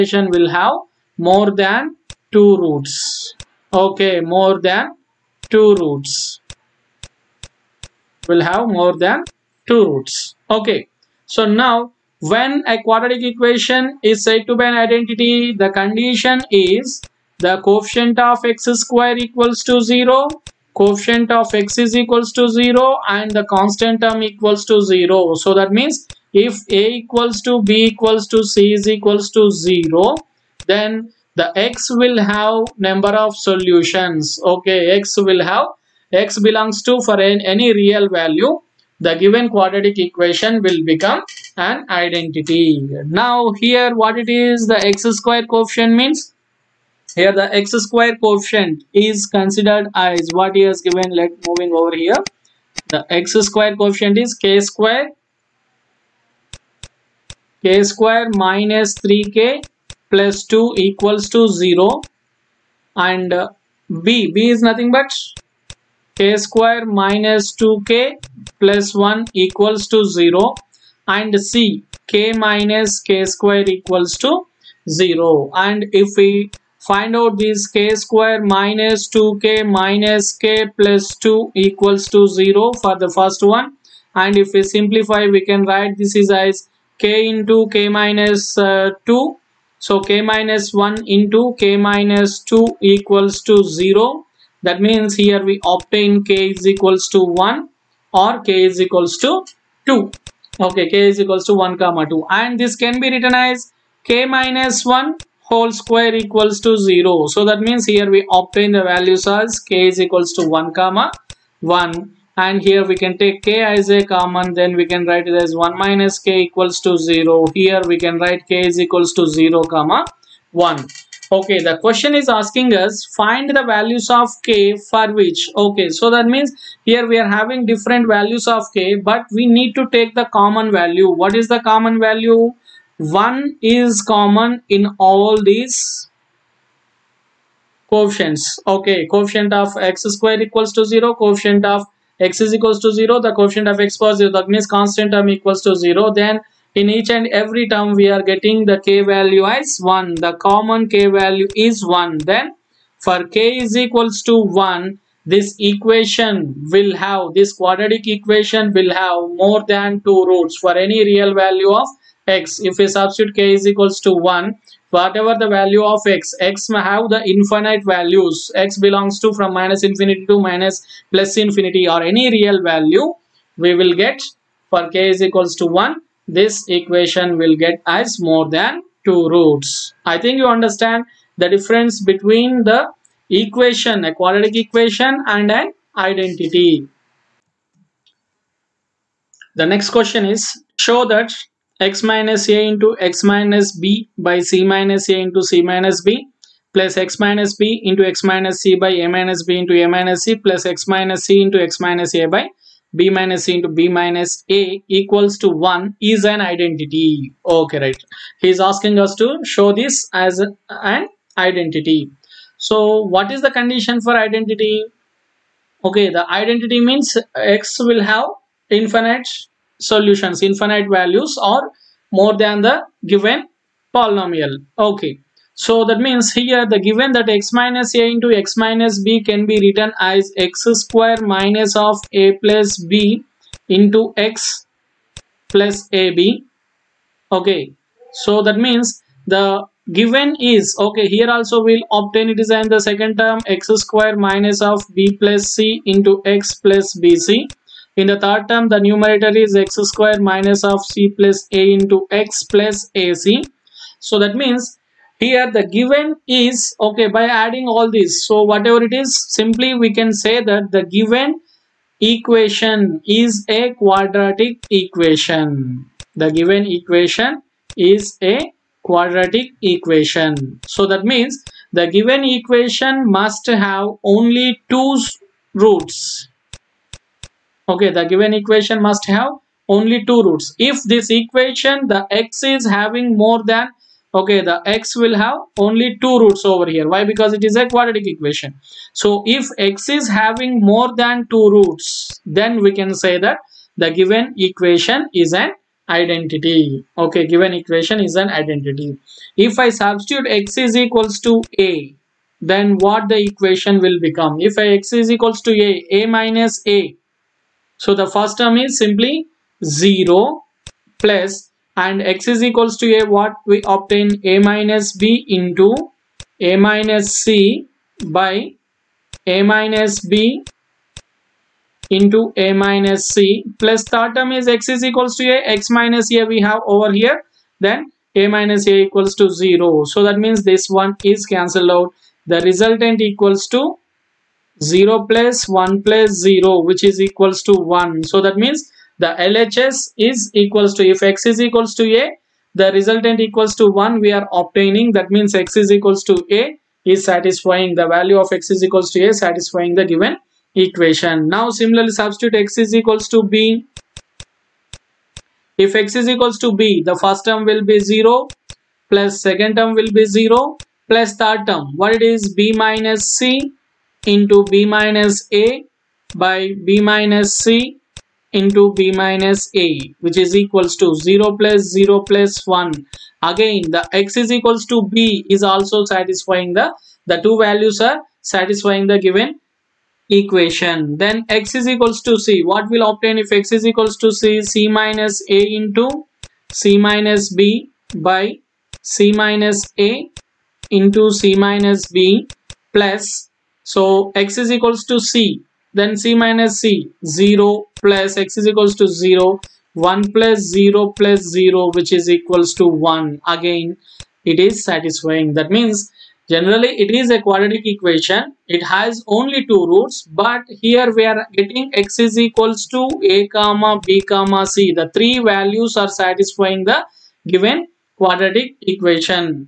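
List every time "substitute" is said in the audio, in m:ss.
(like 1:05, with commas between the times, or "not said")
2:42, 4:59, 5:51.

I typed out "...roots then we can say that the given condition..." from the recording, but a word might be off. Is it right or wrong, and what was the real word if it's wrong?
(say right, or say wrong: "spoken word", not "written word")
wrong: "equation", not "condition".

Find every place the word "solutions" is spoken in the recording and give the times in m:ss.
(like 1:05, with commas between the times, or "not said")
0:33, 3:39.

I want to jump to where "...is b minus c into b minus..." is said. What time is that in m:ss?
6:02.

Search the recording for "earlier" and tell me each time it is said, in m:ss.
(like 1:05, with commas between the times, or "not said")
not said.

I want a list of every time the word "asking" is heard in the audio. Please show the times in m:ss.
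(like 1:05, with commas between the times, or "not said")
2:02, 3:28.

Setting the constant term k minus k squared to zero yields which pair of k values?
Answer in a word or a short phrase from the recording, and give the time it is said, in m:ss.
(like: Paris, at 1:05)
0 and 1, at 1:58.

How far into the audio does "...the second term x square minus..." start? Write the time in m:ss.
4:02.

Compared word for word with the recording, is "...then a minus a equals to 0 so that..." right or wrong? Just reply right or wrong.
right.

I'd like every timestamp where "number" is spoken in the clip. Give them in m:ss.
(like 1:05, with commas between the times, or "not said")
0:32.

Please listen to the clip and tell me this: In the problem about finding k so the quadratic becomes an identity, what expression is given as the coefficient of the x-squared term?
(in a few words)
k^2 - 3k + 2.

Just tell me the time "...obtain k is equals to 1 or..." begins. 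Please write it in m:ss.
1:35.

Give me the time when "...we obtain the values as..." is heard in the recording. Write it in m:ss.
1:48.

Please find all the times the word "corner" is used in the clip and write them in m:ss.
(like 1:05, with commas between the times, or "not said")
not said.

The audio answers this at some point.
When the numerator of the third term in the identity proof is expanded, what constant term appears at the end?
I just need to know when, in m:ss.
4:12.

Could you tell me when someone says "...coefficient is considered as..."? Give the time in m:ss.
0:48.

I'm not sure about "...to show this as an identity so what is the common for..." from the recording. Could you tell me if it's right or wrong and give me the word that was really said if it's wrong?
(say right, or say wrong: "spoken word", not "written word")
wrong: "condition", not "common".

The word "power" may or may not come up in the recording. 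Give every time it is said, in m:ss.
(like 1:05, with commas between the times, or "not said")
2:23.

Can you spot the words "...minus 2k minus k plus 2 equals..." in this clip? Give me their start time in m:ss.
1:18.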